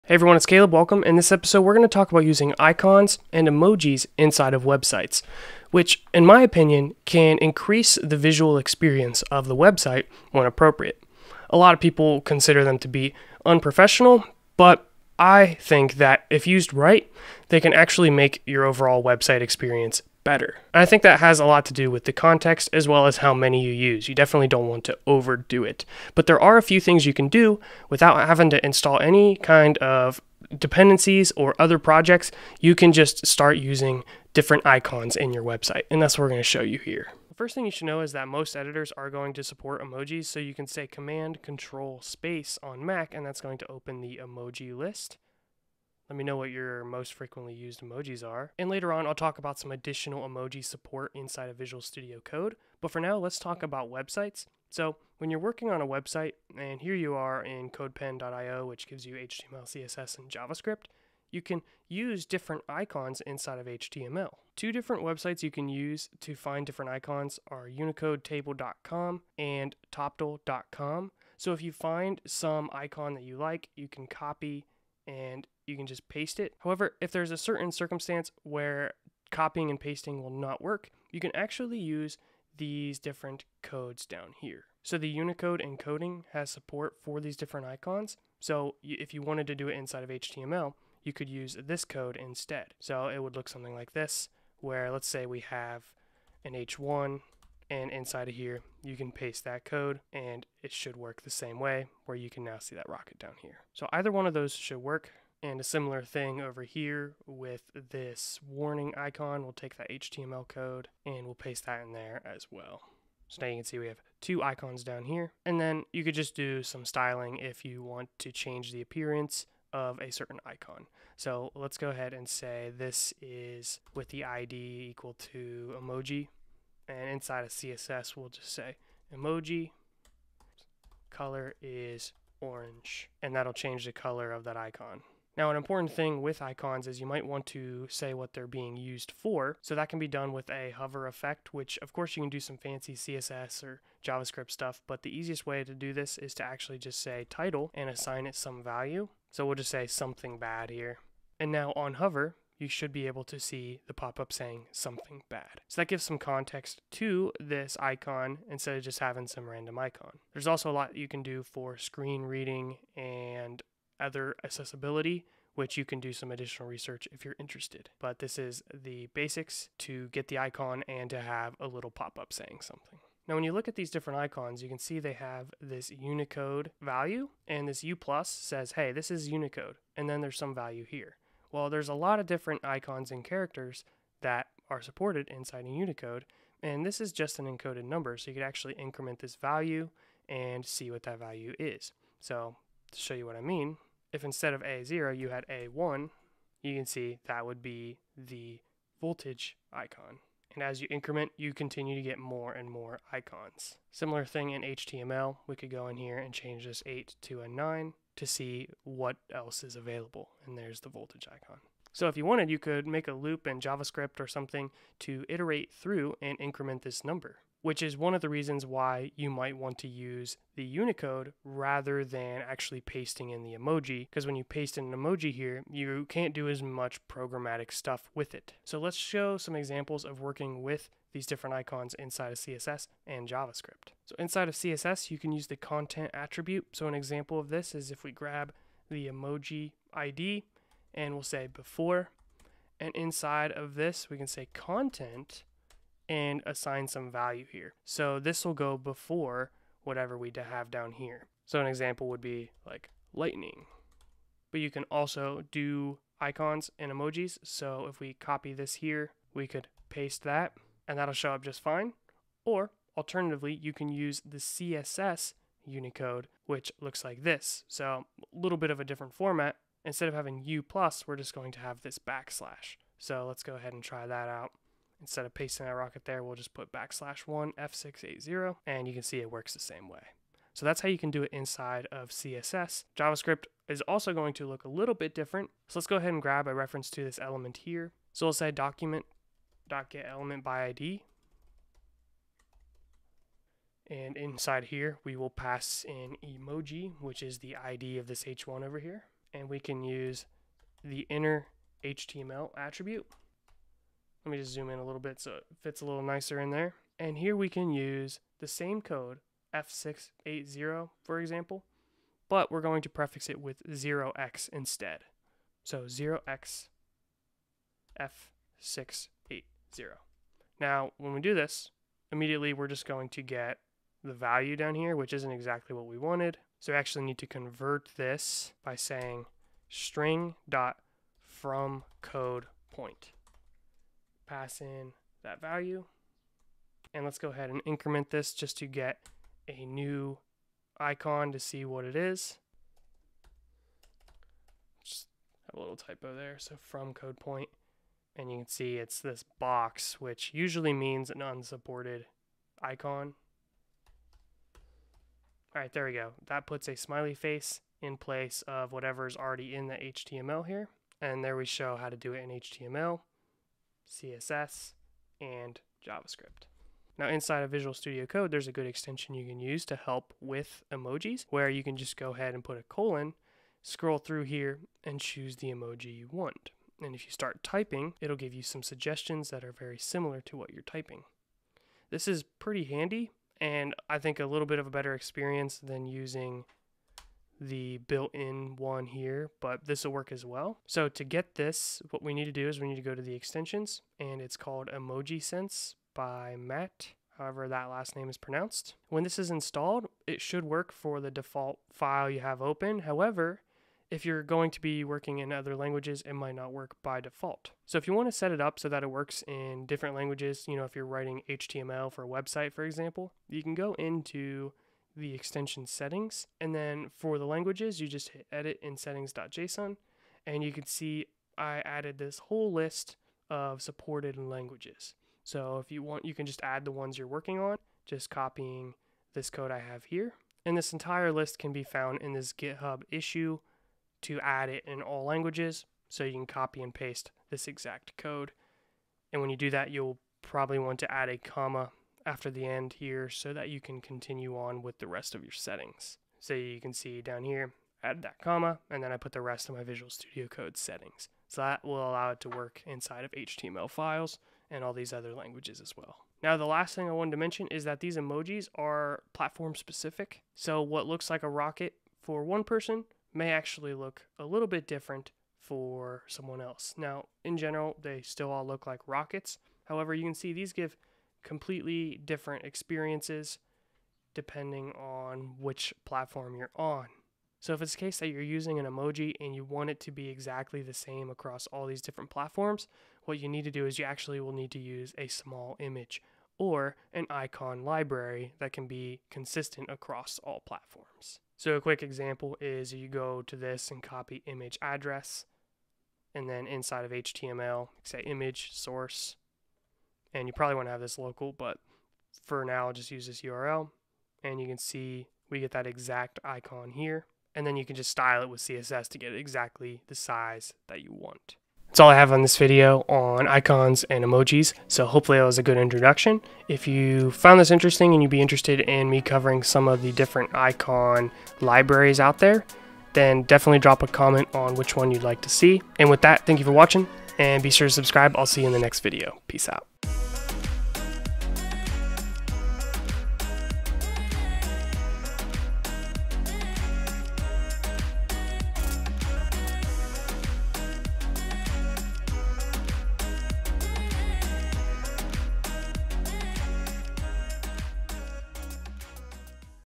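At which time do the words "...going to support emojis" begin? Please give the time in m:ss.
0:39.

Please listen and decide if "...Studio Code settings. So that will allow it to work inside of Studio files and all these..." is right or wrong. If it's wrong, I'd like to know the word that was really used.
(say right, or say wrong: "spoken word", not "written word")
wrong: "HTML", not "Studio".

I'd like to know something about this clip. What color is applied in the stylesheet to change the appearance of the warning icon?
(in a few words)
orange.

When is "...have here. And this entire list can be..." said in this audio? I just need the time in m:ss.
7:09.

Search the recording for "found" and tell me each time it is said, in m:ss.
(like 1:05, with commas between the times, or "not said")
7:11, 8:37.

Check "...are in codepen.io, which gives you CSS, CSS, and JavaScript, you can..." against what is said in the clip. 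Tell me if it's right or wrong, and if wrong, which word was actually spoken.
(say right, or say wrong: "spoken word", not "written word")
wrong: "HTML", not "CSS".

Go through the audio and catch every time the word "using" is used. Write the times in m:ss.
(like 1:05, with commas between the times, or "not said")
0:02, 0:33, 6:25, 7:58.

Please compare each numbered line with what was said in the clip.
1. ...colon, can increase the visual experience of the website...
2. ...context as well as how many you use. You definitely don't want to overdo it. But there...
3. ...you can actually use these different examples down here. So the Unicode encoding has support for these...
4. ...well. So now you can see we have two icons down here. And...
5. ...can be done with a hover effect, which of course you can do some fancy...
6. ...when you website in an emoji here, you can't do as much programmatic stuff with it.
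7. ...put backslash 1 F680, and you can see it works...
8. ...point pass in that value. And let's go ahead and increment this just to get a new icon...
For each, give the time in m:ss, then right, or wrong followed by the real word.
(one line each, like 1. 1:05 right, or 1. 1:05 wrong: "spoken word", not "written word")
1. 0:06 wrong: "opinion", not "colon"
2. 0:22 right
3. 1:21 wrong: "codes", not "examples"
4. 1:52 right
5. 2:19 right
6. 3:44 wrong: "paste", not "website"
7. 4:36 right
8. 5:32 right.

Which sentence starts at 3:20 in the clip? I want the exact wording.
And as you increment, you continue to get more and more icons.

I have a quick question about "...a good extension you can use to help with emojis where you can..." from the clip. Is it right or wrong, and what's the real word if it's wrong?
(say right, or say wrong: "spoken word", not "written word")
right.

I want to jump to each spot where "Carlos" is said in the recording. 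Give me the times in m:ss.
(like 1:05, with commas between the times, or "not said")
not said.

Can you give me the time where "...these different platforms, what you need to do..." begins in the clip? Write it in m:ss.
8:01.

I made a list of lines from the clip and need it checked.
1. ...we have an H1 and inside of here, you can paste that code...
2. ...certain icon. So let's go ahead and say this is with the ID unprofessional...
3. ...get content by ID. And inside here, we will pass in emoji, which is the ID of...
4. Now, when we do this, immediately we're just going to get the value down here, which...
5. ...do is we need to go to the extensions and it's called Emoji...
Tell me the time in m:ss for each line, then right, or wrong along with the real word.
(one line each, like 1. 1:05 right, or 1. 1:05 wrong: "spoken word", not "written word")
1. 1:35 right
2. 2:00 wrong: "equal", not "unprofessional"
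3. 4:49 wrong: "element", not "content"
4. 5:20 right
5. 6:32 right.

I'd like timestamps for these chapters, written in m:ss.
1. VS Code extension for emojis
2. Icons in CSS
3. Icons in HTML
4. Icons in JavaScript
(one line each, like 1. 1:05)
1. 6:06
2. 3:48
3. 1:04
4. 4:42.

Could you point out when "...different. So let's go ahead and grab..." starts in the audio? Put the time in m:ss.
4:45.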